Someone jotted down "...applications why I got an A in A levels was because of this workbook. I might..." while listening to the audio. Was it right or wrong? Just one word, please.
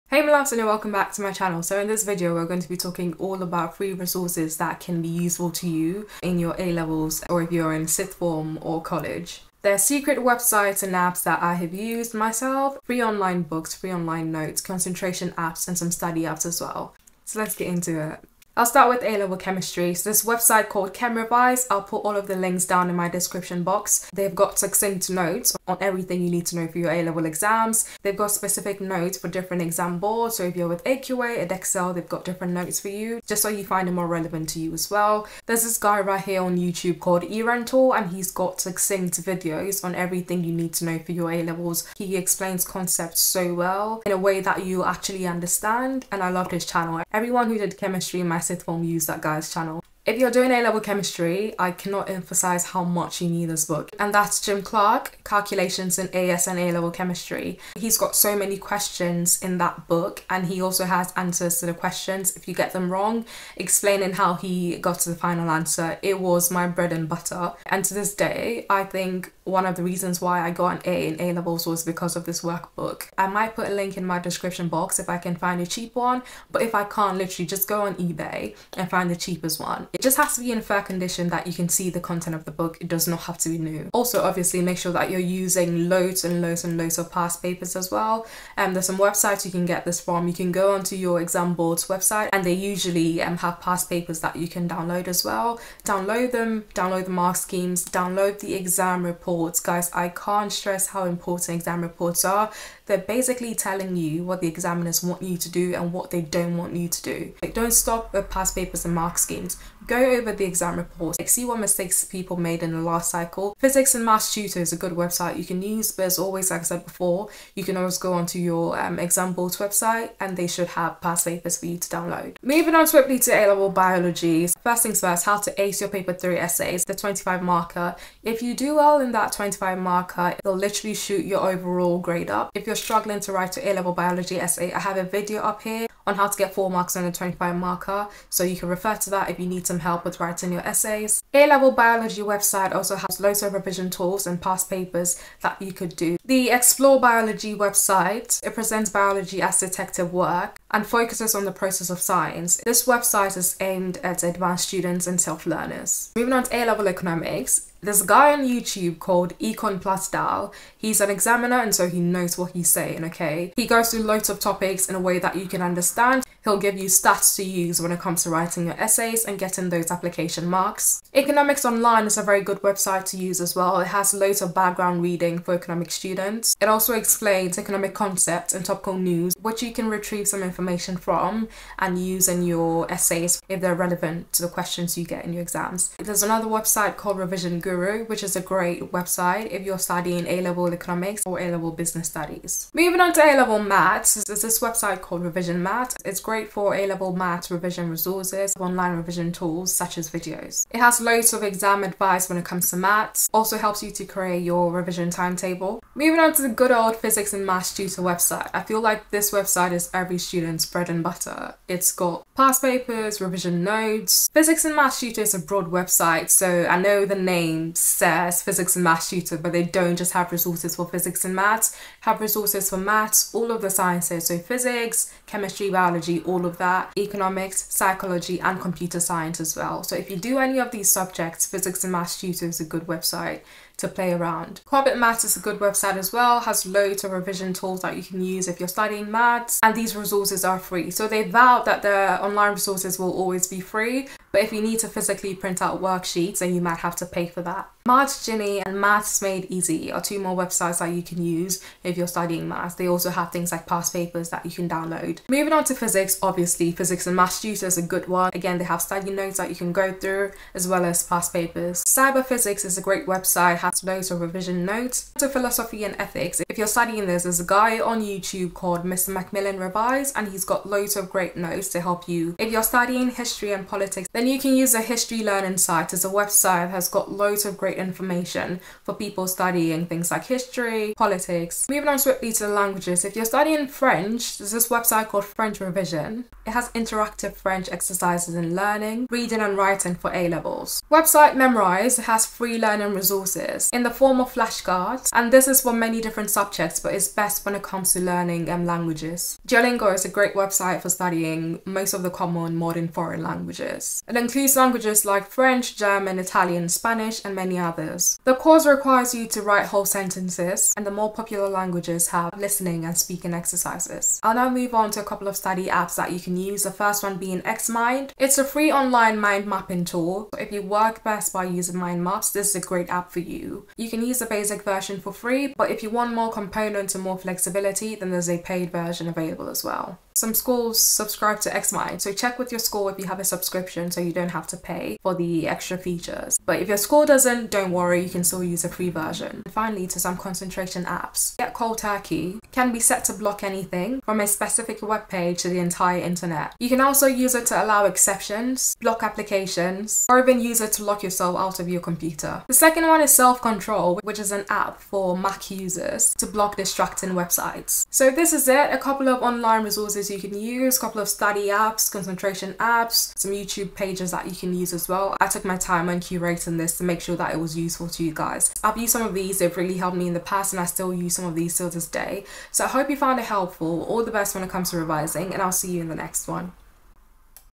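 wrong.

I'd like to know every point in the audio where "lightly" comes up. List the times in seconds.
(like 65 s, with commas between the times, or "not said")
not said.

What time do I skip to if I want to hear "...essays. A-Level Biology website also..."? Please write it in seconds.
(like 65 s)
140 s.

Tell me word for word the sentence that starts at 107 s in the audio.
Like, don't stop with past papers and mark schemes.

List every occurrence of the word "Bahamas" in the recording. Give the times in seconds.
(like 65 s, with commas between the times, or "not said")
not said.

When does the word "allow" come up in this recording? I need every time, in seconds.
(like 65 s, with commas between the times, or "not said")
347 s.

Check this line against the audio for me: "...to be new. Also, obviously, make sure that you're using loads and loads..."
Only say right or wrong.
right.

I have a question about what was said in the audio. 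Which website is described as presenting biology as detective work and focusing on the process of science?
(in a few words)
Explore Biology.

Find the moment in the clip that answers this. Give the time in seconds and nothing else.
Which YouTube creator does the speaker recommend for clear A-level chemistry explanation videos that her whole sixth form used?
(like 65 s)
37 s.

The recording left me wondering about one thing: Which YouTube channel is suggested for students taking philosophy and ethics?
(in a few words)
Mr. McMillan Revise.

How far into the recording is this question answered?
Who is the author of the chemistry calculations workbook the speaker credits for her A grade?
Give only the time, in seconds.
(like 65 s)
54 s.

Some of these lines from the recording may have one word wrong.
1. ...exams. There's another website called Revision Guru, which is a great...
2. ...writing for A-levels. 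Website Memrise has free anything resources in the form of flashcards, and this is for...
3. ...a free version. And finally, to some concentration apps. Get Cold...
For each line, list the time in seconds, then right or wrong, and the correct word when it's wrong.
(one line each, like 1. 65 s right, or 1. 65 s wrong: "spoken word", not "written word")
1. 185 s right
2. 289 s wrong: "learning", not "anything"
3. 338 s right.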